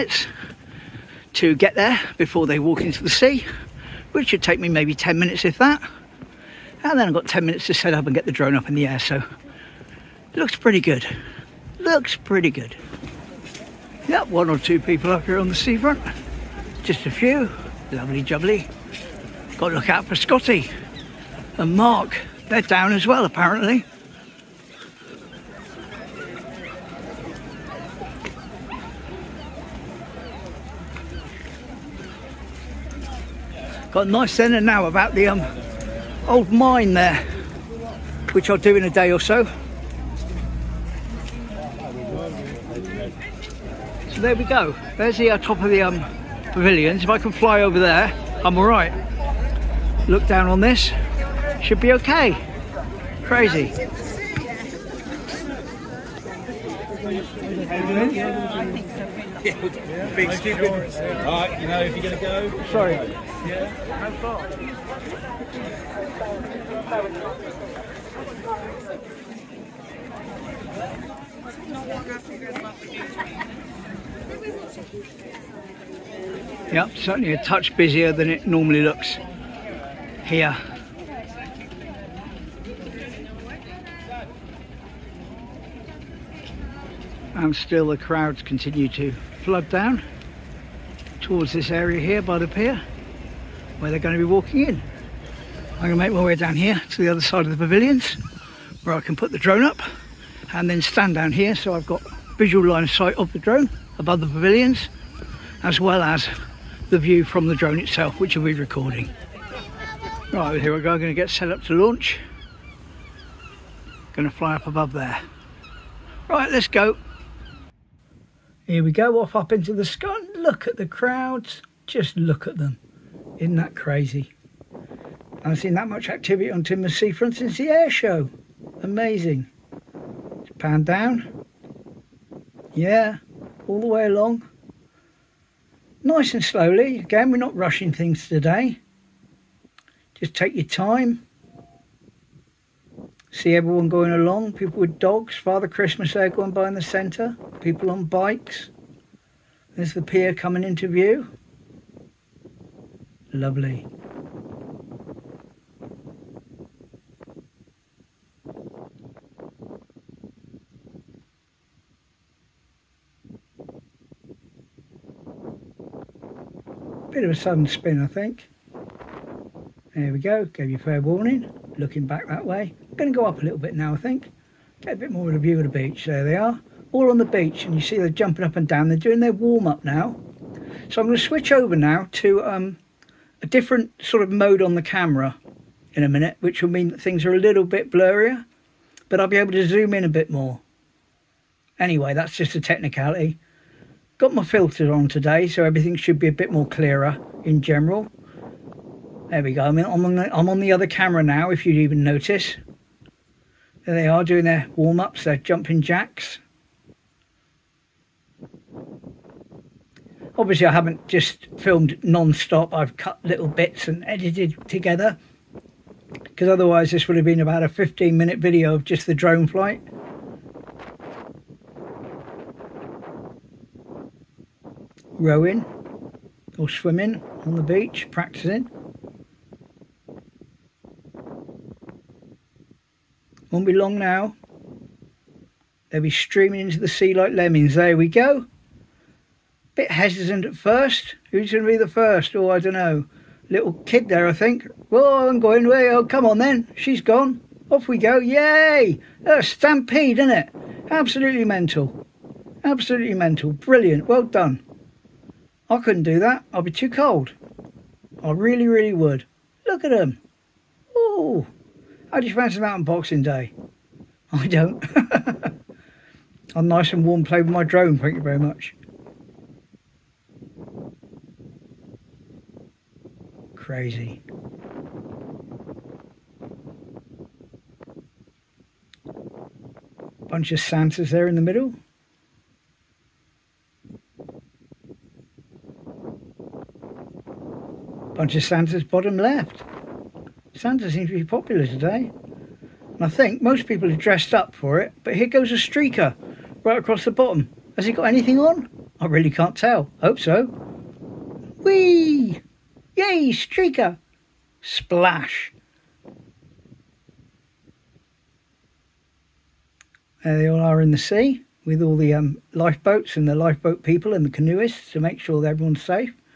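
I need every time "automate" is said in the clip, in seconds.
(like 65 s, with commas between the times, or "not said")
not said.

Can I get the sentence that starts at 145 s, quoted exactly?
Father Christmas there going by in the centre.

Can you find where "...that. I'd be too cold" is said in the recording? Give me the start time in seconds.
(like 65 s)
256 s.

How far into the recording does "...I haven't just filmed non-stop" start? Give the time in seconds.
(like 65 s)
210 s.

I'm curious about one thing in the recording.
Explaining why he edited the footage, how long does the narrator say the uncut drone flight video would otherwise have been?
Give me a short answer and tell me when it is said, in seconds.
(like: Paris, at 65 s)
15 minutes, at 217 s.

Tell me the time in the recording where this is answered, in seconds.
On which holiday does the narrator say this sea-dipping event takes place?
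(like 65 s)
262 s.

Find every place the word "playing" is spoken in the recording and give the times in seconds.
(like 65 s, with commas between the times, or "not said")
267 s.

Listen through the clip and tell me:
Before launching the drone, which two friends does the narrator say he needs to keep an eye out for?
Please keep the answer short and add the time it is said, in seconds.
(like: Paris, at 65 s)
Scotty and Mark, at 20 s.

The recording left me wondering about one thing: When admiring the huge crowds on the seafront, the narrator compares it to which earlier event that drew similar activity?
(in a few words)
the air show.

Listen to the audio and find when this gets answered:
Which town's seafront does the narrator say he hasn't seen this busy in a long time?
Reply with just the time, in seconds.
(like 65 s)
126 s.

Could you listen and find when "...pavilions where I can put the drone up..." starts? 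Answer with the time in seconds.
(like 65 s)
97 s.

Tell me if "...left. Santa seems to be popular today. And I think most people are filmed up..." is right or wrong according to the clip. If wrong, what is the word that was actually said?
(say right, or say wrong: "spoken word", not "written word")
wrong: "dressed", not "filmed".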